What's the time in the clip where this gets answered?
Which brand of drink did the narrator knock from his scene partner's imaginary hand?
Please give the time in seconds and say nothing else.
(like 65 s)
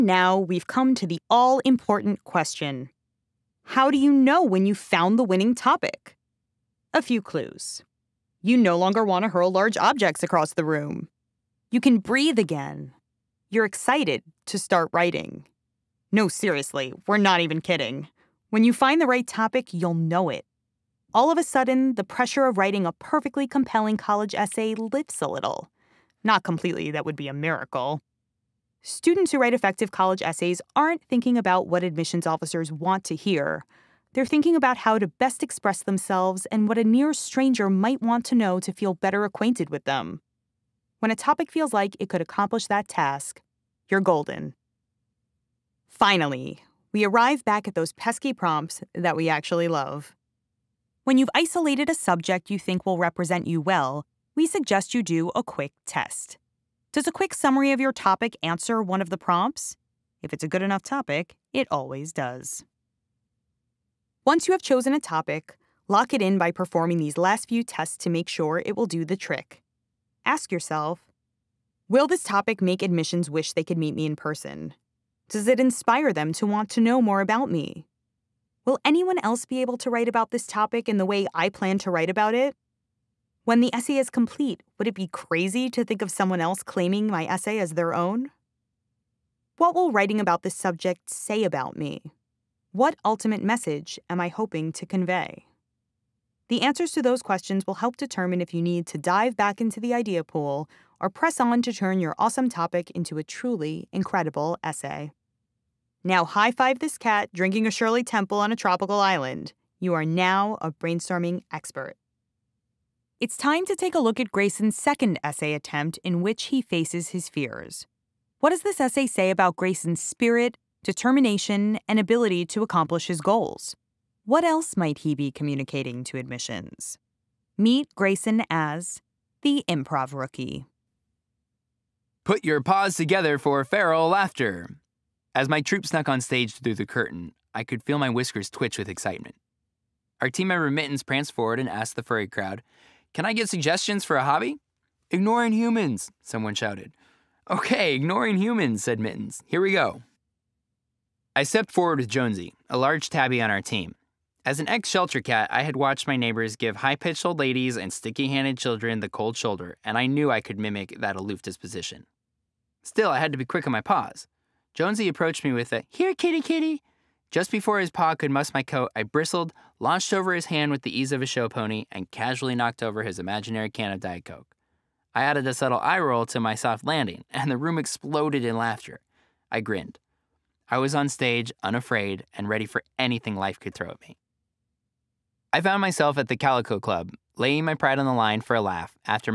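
173 s.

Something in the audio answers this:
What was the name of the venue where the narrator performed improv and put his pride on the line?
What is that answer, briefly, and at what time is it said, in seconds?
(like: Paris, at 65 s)
Calico Club, at 186 s.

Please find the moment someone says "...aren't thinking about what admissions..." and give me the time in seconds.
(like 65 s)
30 s.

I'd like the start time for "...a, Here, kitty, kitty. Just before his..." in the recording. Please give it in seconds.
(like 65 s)
165 s.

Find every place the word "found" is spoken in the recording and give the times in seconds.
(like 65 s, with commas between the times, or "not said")
4 s, 185 s.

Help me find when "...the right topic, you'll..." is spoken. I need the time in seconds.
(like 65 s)
18 s.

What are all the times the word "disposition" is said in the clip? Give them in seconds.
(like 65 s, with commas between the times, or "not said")
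161 s.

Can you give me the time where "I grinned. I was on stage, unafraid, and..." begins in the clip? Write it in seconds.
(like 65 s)
179 s.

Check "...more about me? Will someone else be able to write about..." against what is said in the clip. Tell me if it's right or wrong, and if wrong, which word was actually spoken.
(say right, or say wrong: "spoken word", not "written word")
wrong: "anyone", not "someone".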